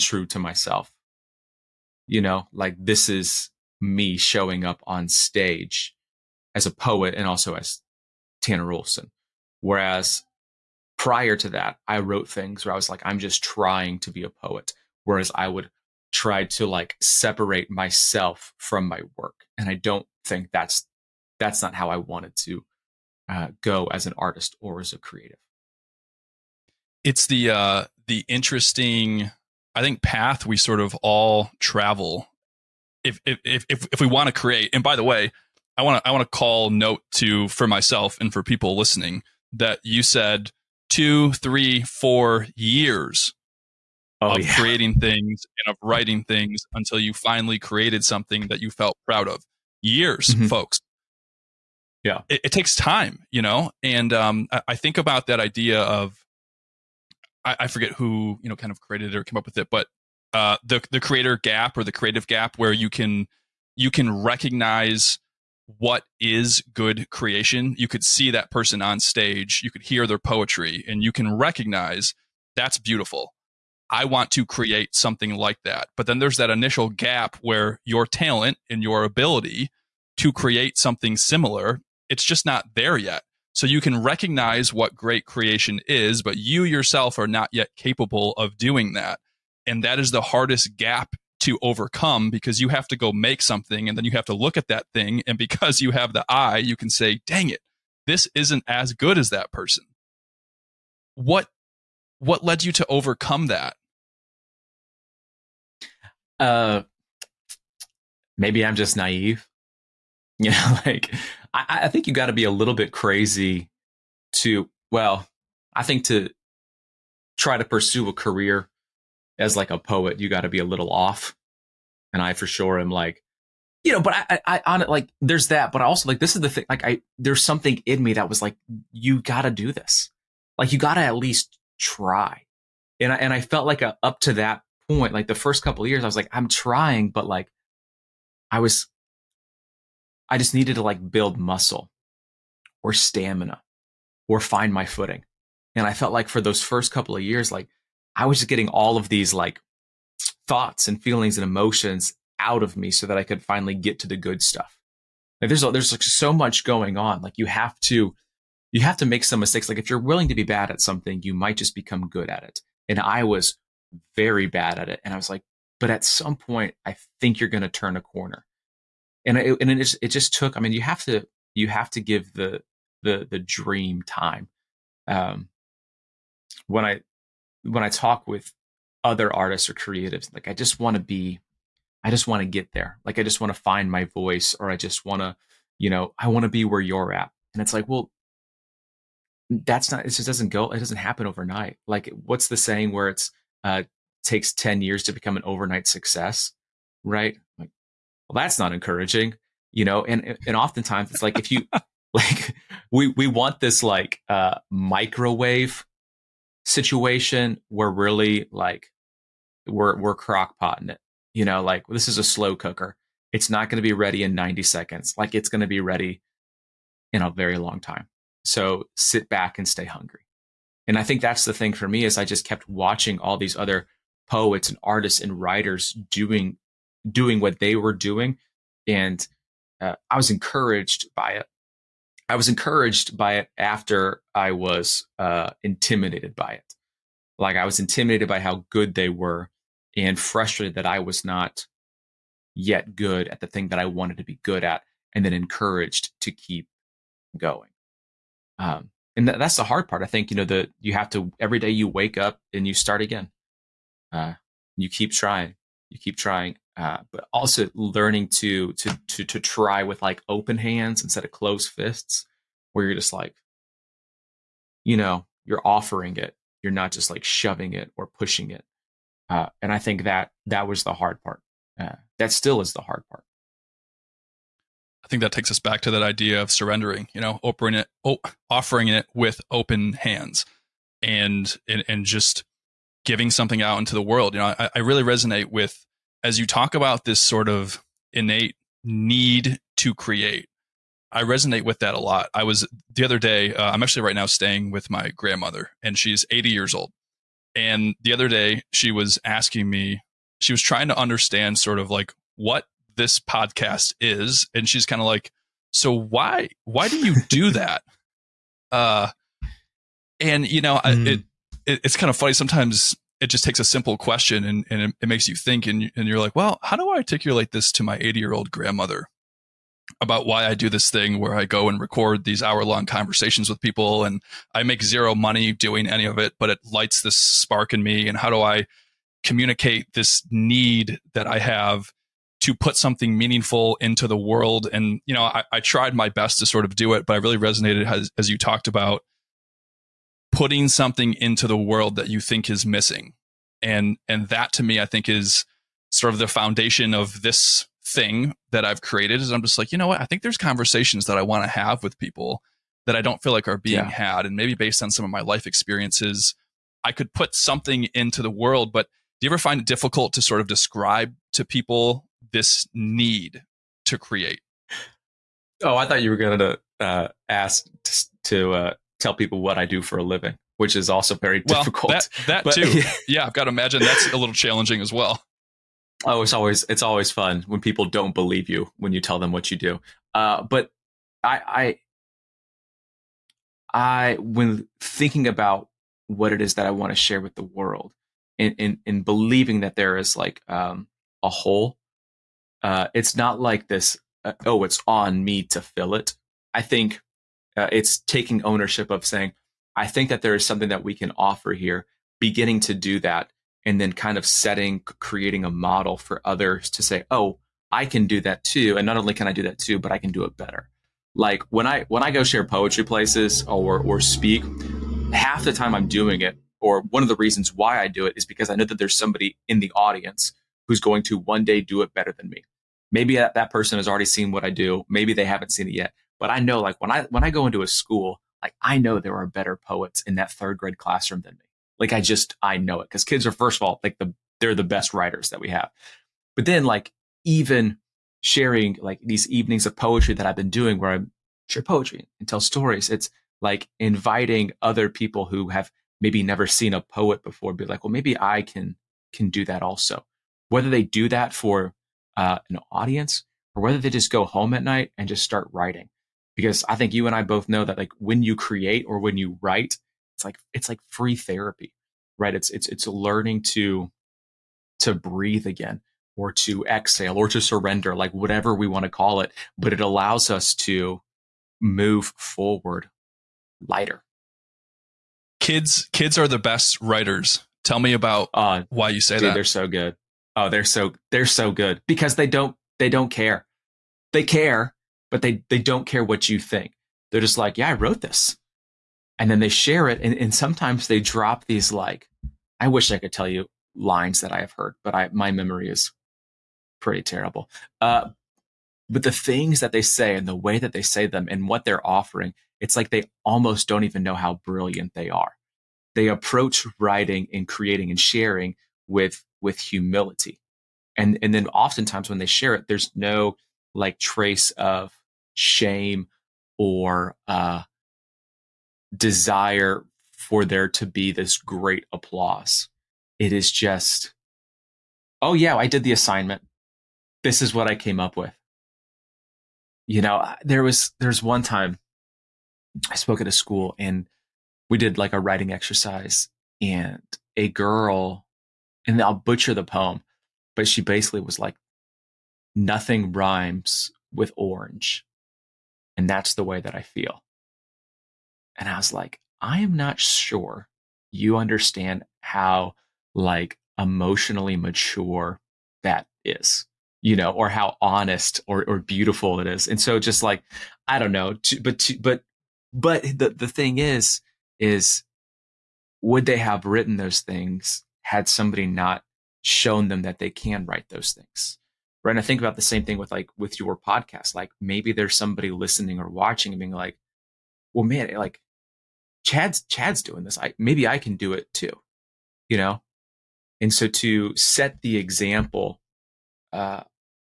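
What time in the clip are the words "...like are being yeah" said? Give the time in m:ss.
5:53.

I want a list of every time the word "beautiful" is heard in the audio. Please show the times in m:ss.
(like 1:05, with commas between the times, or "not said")
1:12, 9:18.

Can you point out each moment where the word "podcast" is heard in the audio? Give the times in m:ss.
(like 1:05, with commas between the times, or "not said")
5:03, 9:33.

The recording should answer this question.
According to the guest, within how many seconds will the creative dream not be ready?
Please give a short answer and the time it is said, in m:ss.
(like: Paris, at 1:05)
90 seconds, at 3:34.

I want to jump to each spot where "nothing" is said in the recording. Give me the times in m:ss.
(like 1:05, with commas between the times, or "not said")
9:02.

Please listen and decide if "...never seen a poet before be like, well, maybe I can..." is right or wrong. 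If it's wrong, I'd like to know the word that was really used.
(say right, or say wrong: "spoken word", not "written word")
right.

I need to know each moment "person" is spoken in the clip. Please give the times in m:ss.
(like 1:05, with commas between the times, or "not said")
1:08, 1:39, 7:03.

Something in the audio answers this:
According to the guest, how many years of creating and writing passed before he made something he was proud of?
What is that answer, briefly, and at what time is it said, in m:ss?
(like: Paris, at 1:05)
2, 3, 4 years, at 0:40.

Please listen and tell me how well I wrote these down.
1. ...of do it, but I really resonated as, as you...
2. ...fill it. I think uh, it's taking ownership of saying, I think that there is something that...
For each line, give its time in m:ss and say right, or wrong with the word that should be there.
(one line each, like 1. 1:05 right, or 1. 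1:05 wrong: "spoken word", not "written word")
1. 5:36 right
2. 6:35 right.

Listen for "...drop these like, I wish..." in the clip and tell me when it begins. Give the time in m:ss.
8:10.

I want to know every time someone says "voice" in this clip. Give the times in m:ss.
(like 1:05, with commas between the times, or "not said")
3:04.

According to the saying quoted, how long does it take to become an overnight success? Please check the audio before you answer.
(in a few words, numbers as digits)
10 years.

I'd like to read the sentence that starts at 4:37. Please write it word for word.
You know, offering it, oh, offering it with open hands, and and and just giving something out into the world.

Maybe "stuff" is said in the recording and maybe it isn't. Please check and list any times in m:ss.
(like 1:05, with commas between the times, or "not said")
2:34.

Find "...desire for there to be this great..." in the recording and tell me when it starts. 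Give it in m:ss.
8:38.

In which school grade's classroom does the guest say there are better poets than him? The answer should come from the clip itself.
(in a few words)
third grade.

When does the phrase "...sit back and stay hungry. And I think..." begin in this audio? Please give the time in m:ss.
3:38.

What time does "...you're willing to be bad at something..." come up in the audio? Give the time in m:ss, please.
2:39.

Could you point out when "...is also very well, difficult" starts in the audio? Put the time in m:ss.
6:10.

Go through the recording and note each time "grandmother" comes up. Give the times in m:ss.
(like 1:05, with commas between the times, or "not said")
4:55, 5:18.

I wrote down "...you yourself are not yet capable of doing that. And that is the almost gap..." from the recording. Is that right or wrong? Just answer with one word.
wrong.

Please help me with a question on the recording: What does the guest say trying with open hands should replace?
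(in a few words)
closed fists.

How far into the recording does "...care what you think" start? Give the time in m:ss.
8:05.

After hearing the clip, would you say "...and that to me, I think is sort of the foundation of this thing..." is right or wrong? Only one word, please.
right.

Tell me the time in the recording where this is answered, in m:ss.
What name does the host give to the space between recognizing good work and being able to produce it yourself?
1:01.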